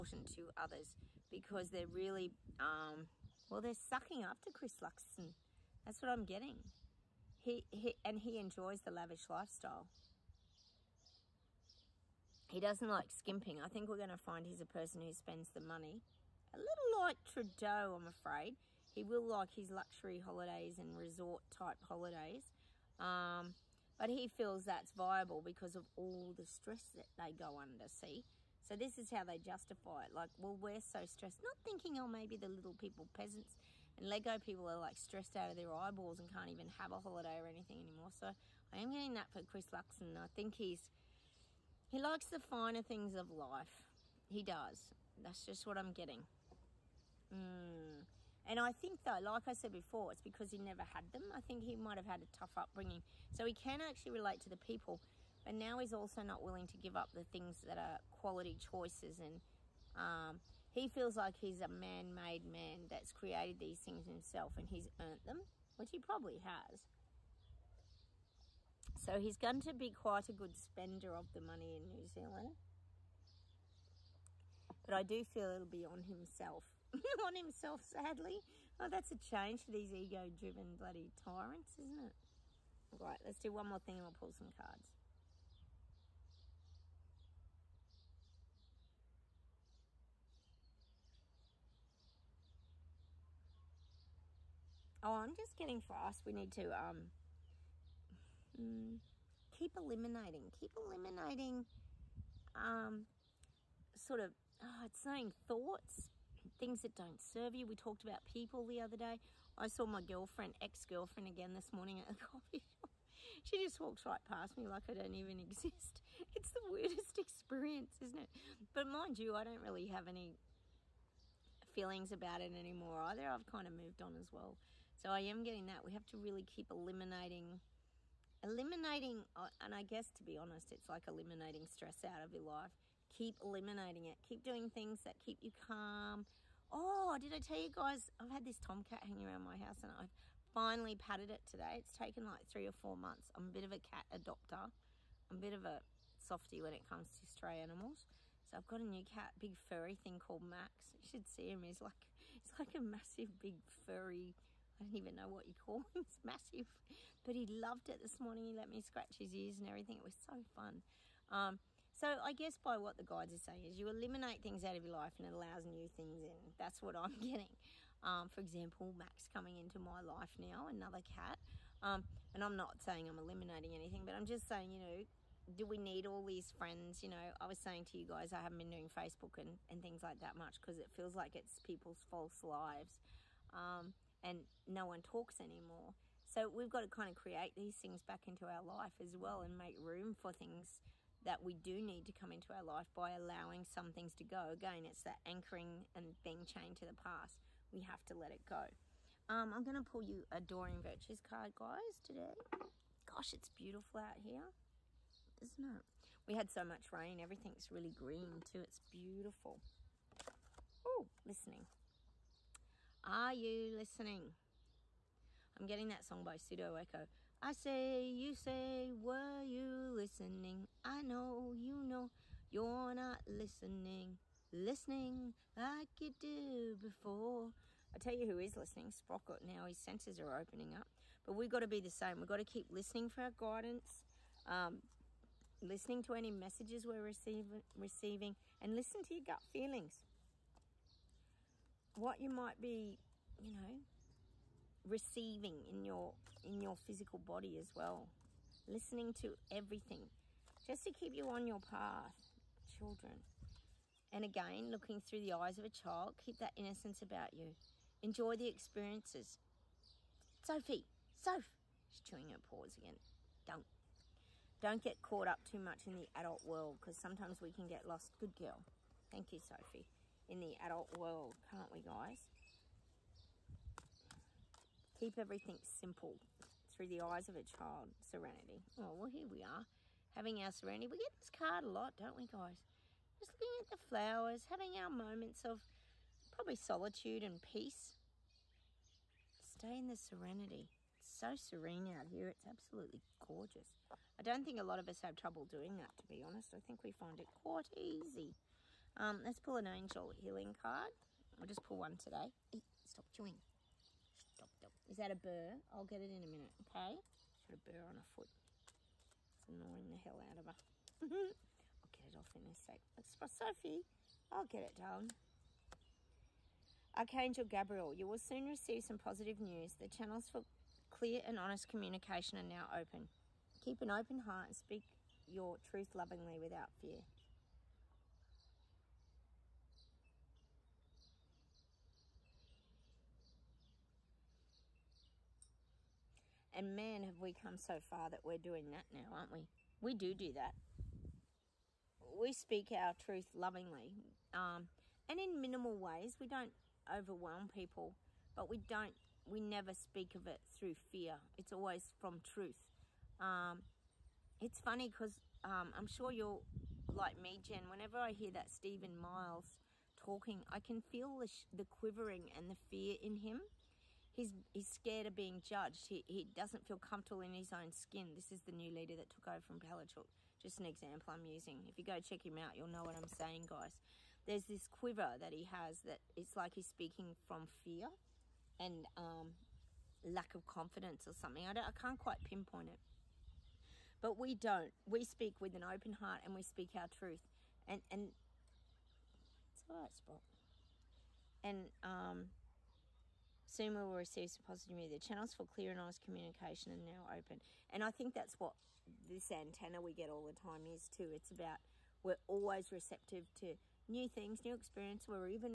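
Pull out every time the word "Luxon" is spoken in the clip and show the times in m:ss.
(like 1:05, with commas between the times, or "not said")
0:04, 0:39.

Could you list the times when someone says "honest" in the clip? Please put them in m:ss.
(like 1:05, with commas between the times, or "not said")
2:10, 4:56, 5:21, 6:35.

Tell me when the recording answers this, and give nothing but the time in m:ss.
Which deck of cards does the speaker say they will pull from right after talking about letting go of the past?
3:20.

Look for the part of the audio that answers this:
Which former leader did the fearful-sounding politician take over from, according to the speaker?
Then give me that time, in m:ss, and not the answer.
6:09.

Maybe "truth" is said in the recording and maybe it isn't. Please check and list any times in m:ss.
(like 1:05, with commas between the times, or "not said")
5:25, 5:42, 5:52, 6:26.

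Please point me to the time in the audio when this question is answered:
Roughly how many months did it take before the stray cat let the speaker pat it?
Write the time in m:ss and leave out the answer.
2:22.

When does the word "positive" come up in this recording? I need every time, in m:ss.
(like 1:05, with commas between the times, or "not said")
5:18, 6:34.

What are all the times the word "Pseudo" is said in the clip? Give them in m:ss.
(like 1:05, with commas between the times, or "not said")
3:36.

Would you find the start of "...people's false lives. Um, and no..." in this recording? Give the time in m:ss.
3:01.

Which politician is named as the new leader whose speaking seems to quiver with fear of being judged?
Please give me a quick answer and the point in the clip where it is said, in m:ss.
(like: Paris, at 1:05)
Steven Miles, at 5:58.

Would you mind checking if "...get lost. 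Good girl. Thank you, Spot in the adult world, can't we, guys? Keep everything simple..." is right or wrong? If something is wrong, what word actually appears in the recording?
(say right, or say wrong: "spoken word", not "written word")
wrong: "Sophie", not "Spot".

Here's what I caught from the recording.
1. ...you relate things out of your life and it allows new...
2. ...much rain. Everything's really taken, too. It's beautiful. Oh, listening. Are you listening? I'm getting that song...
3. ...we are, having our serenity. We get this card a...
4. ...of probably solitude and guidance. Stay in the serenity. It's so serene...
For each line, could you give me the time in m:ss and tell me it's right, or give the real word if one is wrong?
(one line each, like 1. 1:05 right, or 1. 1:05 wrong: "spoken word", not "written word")
1. 2:43 wrong: "eliminate", not "relate"
2. 3:26 wrong: "green", not "taken"
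3. 4:39 right
4. 4:45 wrong: "peace", not "guidance".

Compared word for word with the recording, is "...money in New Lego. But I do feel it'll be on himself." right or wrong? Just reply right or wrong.
wrong.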